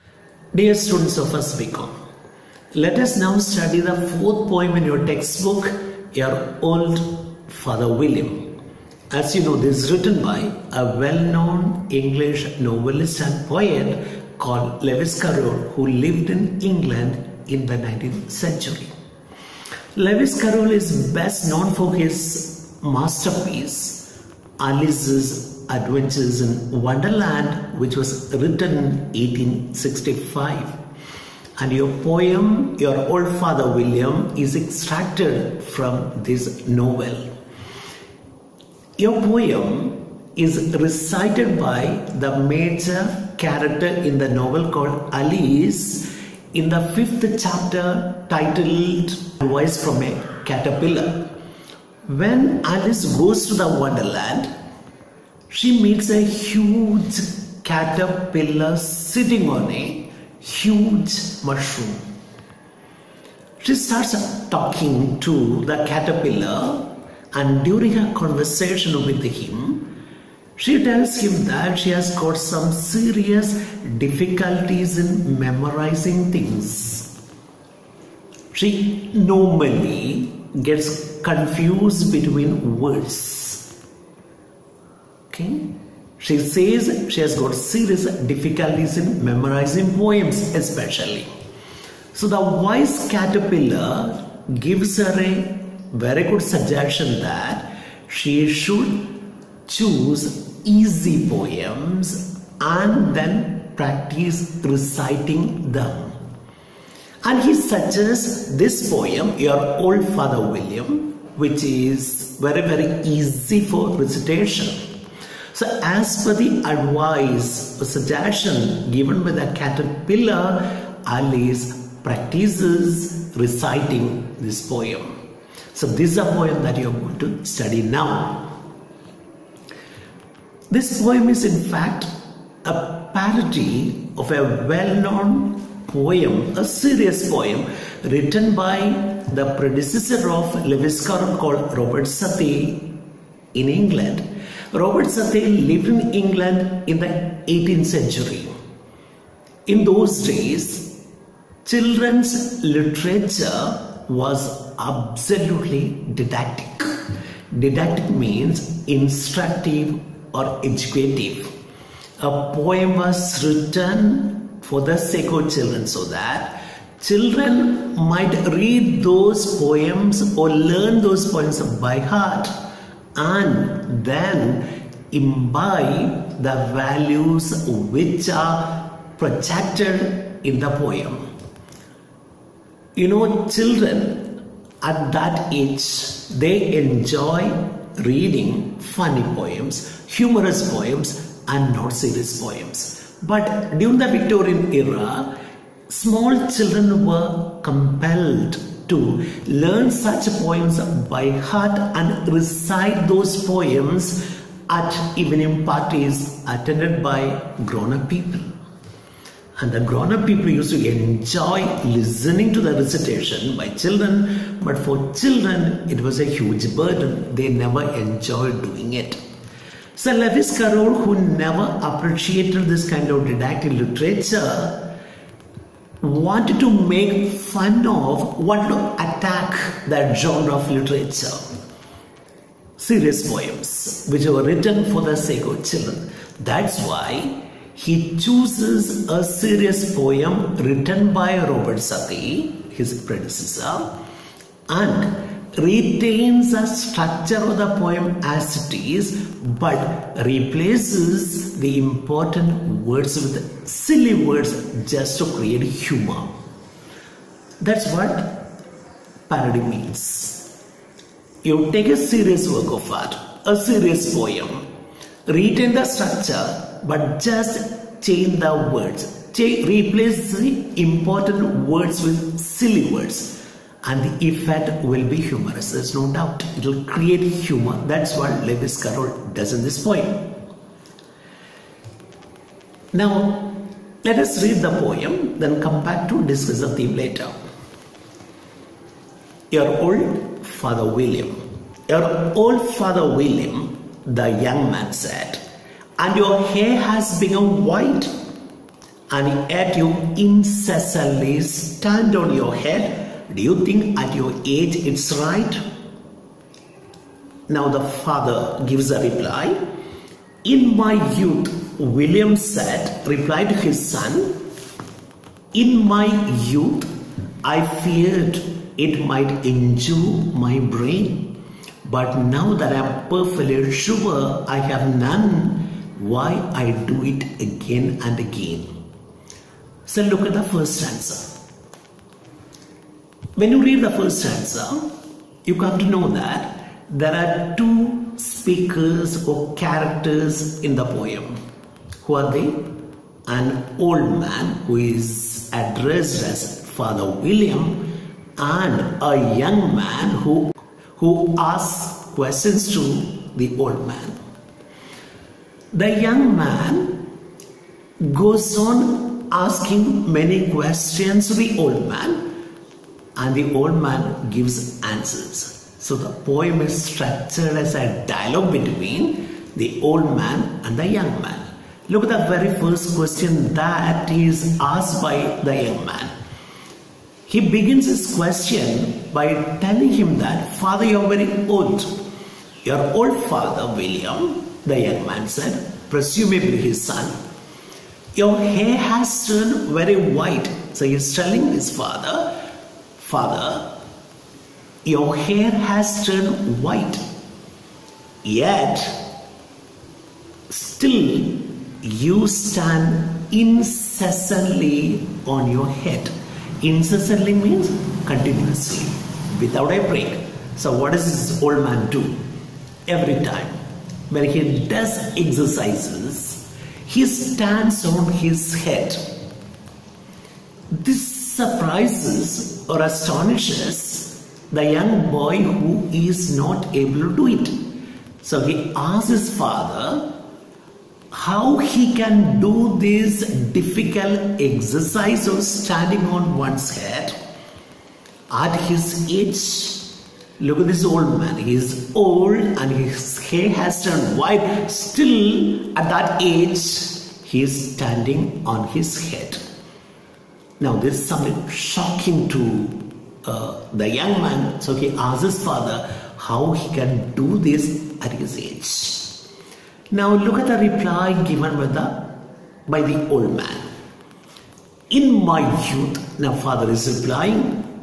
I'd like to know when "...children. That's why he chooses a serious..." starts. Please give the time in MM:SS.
03:55.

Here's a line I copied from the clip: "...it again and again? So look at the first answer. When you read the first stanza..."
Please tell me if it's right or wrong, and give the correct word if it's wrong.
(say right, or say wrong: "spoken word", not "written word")
right.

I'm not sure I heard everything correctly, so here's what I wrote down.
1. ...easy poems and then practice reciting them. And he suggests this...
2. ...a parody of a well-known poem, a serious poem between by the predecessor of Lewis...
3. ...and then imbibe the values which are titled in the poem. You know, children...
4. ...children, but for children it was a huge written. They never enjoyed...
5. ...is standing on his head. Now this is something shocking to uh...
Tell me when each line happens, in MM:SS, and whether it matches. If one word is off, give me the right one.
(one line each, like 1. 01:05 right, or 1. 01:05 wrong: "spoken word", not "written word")
1. 01:40 right
2. 02:12 wrong: "written", not "between"
3. 02:53 wrong: "projected", not "titled"
4. 03:33 wrong: "burden", not "written"
5. 07:27 right.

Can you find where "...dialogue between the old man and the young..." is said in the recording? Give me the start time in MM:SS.
06:08.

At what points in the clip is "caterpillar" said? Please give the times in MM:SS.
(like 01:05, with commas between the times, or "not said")
00:50, 00:57, 01:05, 01:33, 01:59.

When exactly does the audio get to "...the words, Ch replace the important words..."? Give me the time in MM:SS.
04:28.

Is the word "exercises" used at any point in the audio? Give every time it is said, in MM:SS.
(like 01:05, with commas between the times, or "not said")
06:55, 07:14.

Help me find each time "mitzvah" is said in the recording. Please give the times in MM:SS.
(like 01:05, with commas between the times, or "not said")
not said.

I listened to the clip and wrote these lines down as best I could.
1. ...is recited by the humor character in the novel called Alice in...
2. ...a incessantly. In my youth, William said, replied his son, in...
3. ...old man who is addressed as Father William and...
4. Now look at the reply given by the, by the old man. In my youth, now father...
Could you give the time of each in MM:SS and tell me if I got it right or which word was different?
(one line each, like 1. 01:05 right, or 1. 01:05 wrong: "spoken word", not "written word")
1. 00:40 wrong: "major", not "humor"
2. 05:08 wrong: "reply", not "incessantly"
3. 05:43 right
4. 07:39 right.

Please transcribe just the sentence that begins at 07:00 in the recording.
This surprises or astonishes the young boy who is not able to do it.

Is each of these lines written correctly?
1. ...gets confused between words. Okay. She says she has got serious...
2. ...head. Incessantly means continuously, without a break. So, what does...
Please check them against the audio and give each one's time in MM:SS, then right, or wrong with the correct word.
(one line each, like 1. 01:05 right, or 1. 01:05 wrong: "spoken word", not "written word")
1. 01:20 right
2. 06:45 right.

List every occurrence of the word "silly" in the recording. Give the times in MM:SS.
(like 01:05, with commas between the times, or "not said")
04:13, 04:32.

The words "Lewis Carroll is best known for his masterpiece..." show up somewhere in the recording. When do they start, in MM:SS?
00:19.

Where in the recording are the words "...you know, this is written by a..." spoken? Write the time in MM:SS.
00:09.